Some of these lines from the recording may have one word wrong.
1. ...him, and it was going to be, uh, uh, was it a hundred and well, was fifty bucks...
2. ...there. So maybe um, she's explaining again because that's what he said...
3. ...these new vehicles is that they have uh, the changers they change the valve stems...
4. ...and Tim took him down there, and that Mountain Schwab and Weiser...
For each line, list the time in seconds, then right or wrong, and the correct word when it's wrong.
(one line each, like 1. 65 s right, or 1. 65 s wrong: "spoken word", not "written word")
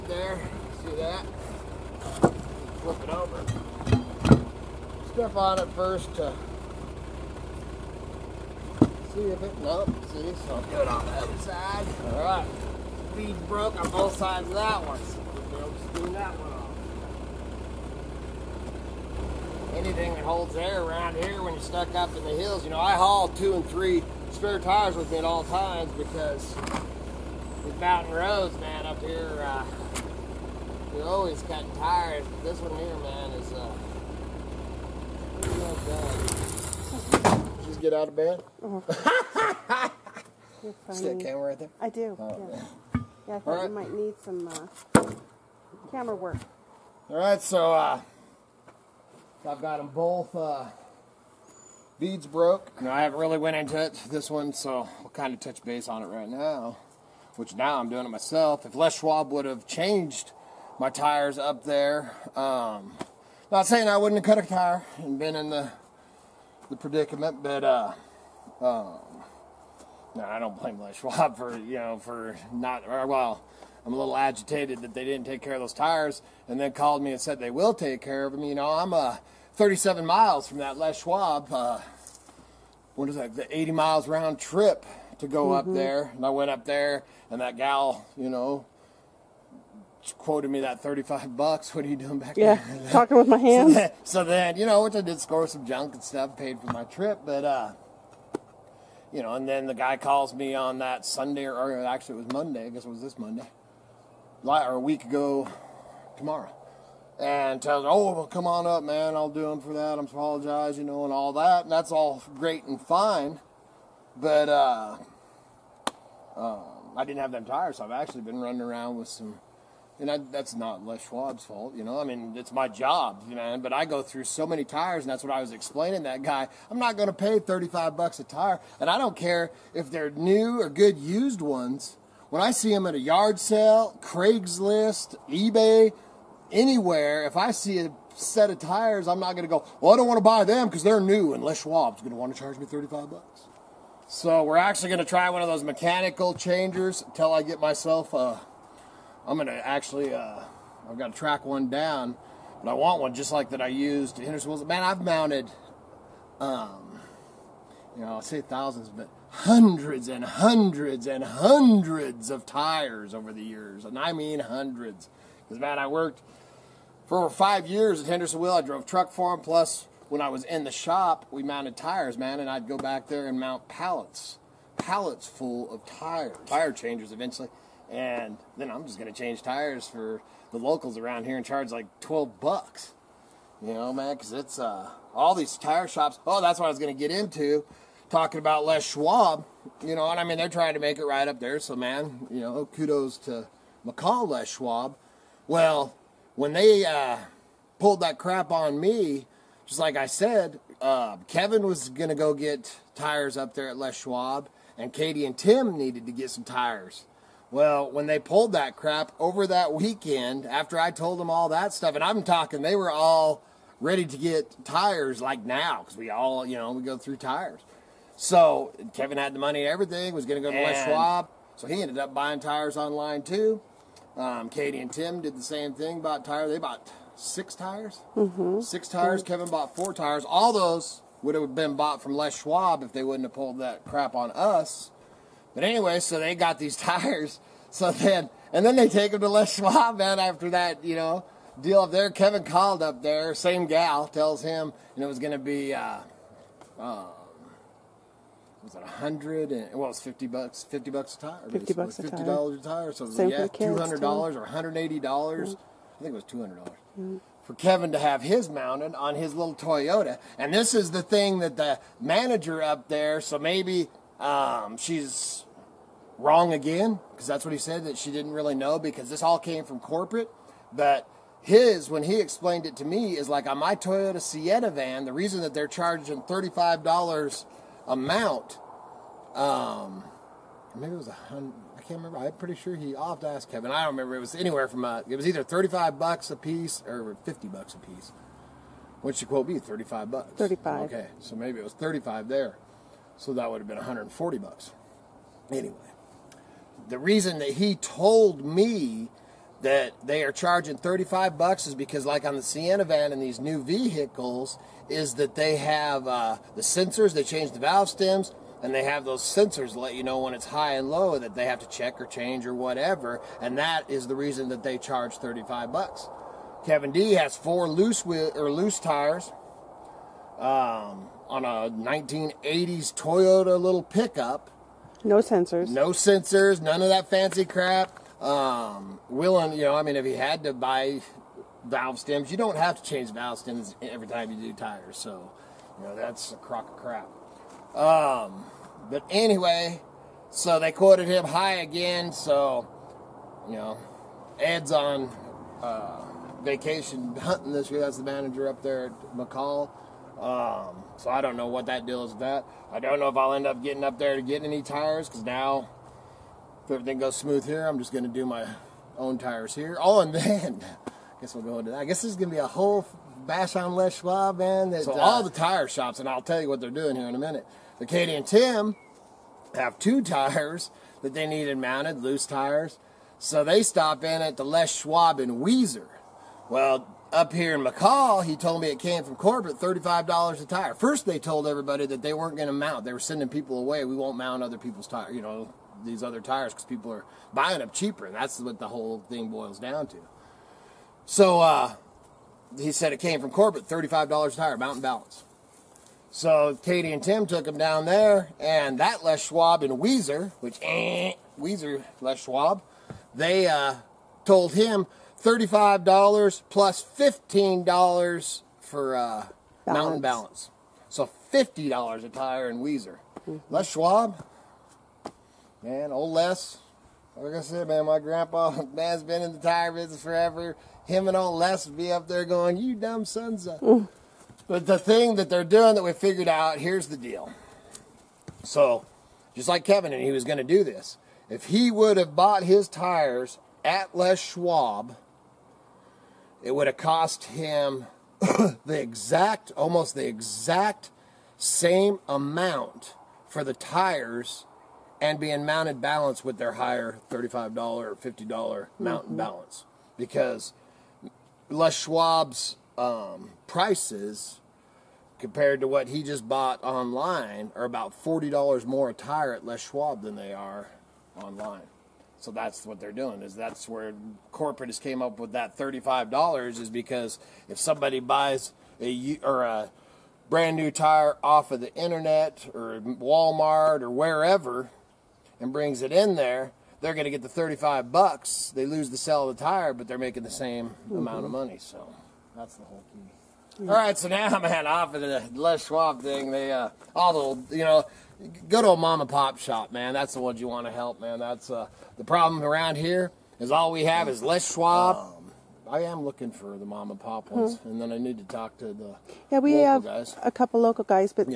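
1. 244 s right
2. 262 s wrong: "wrong", not "explaining"
3. 303 s wrong: "sensors", not "changers"
4. 396 s wrong: "Les", not "Mountain".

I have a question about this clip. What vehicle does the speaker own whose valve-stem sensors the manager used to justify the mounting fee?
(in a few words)
Toyota Sienna van.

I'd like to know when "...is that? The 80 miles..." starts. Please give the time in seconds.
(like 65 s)
83 s.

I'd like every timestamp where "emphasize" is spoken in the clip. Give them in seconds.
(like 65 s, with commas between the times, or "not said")
not said.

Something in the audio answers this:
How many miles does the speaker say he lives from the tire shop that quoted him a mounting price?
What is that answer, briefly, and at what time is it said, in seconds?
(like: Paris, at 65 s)
37, at 79 s.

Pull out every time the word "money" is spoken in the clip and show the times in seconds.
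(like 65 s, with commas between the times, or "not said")
219 s, 481 s.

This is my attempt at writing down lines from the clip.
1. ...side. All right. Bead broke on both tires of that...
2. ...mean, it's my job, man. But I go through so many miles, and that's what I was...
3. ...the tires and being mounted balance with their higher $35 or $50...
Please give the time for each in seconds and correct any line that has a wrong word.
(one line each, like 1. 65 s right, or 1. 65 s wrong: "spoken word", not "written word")
1. 11 s wrong: "sides", not "tires"
2. 122 s wrong: "tires", not "miles"
3. 443 s right.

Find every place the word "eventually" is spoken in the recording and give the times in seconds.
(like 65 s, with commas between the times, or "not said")
177 s.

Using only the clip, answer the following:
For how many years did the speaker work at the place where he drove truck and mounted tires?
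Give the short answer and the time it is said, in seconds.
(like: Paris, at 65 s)
5, at 167 s.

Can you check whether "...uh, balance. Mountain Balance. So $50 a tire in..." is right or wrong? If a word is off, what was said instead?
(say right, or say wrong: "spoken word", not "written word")
right.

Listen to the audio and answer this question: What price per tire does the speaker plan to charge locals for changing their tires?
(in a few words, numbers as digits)
$12.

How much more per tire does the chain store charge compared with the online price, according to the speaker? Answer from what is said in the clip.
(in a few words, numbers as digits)
$40.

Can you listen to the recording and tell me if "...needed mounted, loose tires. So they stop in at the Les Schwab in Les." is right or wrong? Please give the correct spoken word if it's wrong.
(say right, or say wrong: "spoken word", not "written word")
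wrong: "Weiser", not "Les".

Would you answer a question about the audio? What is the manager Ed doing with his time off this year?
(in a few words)
hunting.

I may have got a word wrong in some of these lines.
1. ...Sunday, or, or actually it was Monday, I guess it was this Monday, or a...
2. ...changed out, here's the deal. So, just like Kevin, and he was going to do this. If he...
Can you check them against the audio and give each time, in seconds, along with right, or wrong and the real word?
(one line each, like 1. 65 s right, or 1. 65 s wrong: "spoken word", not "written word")
1. 101 s right
2. 425 s wrong: "figured", not "changed".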